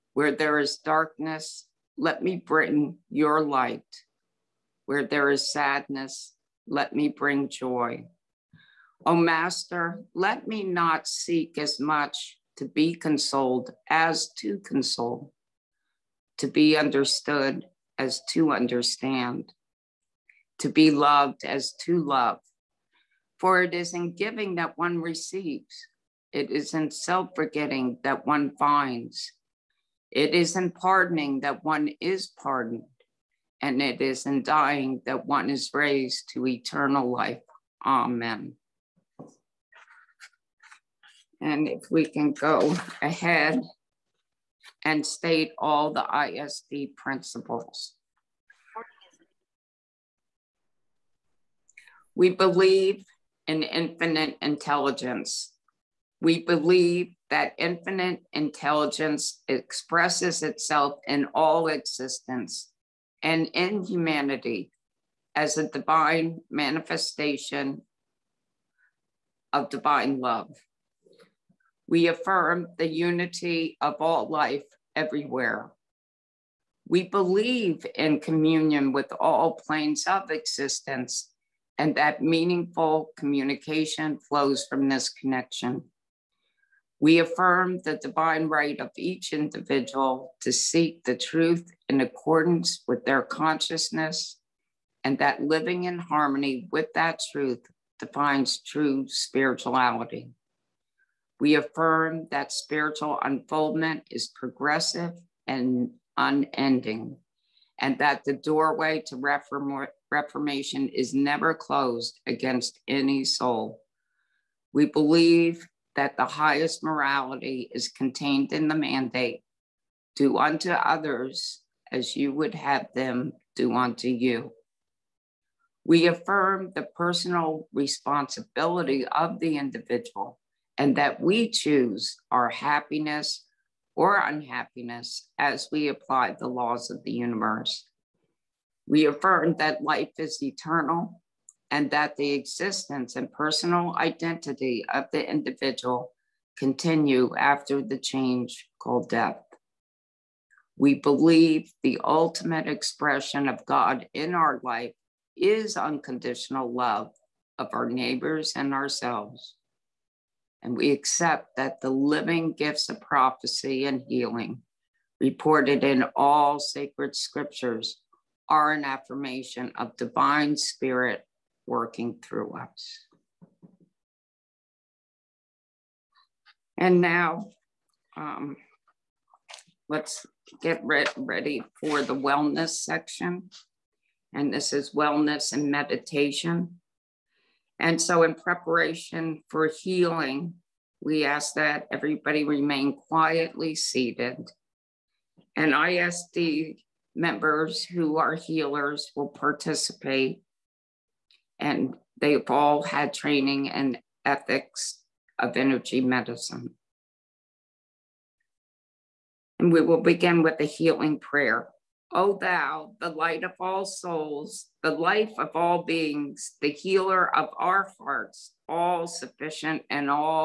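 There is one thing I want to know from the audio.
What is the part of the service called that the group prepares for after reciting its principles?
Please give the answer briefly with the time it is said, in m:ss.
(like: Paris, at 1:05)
Wellness and meditation, at 3:04.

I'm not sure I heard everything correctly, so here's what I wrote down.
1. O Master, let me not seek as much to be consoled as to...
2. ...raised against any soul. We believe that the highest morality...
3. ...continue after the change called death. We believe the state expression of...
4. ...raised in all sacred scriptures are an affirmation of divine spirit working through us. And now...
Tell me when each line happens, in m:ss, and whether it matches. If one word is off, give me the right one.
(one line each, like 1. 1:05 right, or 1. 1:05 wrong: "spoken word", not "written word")
1. 0:09 right
2. 1:51 wrong: "closed", not "raised"
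3. 2:26 wrong: "ultimate", not "state"
4. 2:45 wrong: "reported", not "raised".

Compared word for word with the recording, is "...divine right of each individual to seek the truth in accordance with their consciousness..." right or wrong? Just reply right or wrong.
right.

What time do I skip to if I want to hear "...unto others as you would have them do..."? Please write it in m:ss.
2:00.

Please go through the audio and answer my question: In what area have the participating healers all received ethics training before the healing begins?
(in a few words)
Energy medicine.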